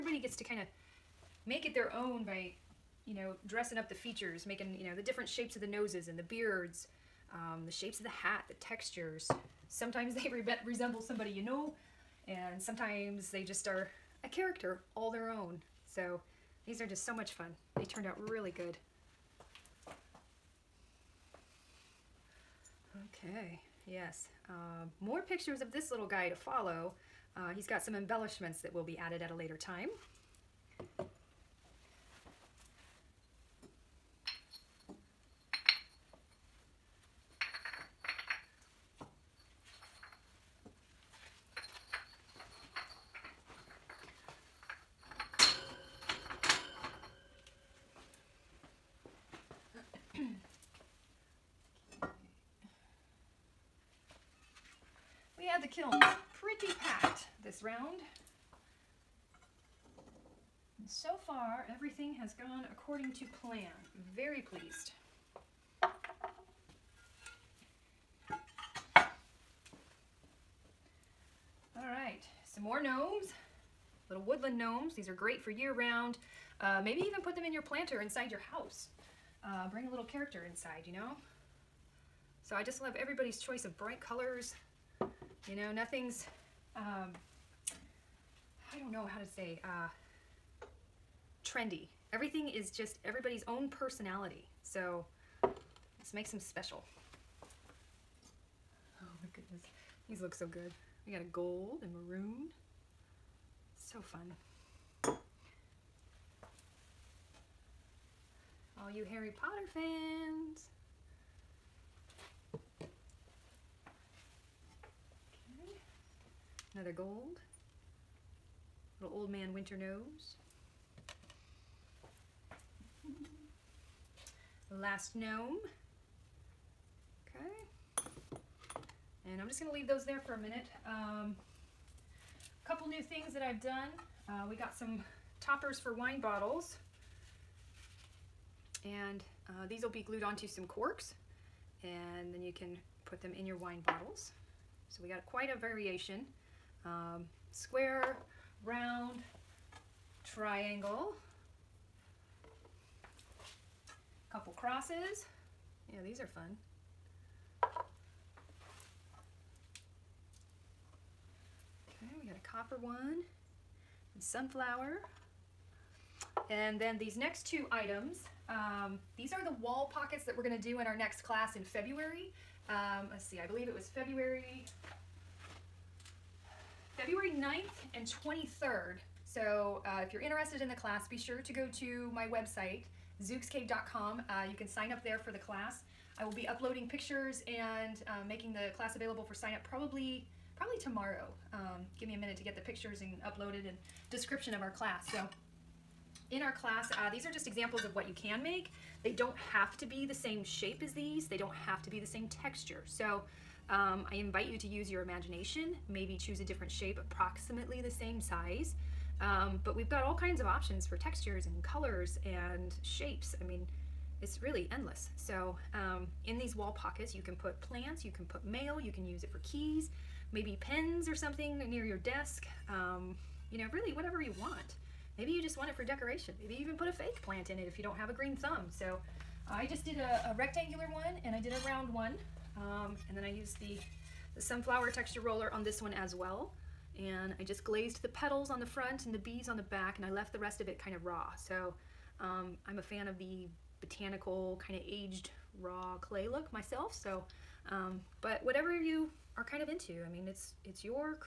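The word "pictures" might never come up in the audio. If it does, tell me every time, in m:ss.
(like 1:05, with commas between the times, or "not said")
0:25, 3:06, 3:12.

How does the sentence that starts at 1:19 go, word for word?
Uh, bring a little character inside, you know?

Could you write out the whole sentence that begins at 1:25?
You know, nothing's, um, I don't know how to say, uh, trendy.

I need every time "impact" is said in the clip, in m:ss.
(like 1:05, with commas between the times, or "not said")
not said.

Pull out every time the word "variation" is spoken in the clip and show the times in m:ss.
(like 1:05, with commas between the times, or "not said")
2:25.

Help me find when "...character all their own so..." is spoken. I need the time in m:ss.
0:14.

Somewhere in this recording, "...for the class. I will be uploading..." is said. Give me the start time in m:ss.
3:05.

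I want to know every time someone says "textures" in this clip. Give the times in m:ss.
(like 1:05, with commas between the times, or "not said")
0:08, 3:22, 3:30, 3:54.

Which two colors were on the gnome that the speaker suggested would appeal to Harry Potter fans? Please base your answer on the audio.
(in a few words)
gold and maroon.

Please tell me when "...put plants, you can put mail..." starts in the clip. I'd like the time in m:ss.
3:37.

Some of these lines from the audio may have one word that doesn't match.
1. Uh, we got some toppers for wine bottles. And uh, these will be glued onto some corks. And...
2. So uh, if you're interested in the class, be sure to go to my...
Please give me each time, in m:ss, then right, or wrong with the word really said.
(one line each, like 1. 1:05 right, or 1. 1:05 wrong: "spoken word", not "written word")
1. 2:14 right
2. 2:59 right.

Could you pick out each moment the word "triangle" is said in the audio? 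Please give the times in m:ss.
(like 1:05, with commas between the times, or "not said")
2:30.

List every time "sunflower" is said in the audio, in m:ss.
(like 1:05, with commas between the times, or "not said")
2:44, 3:54.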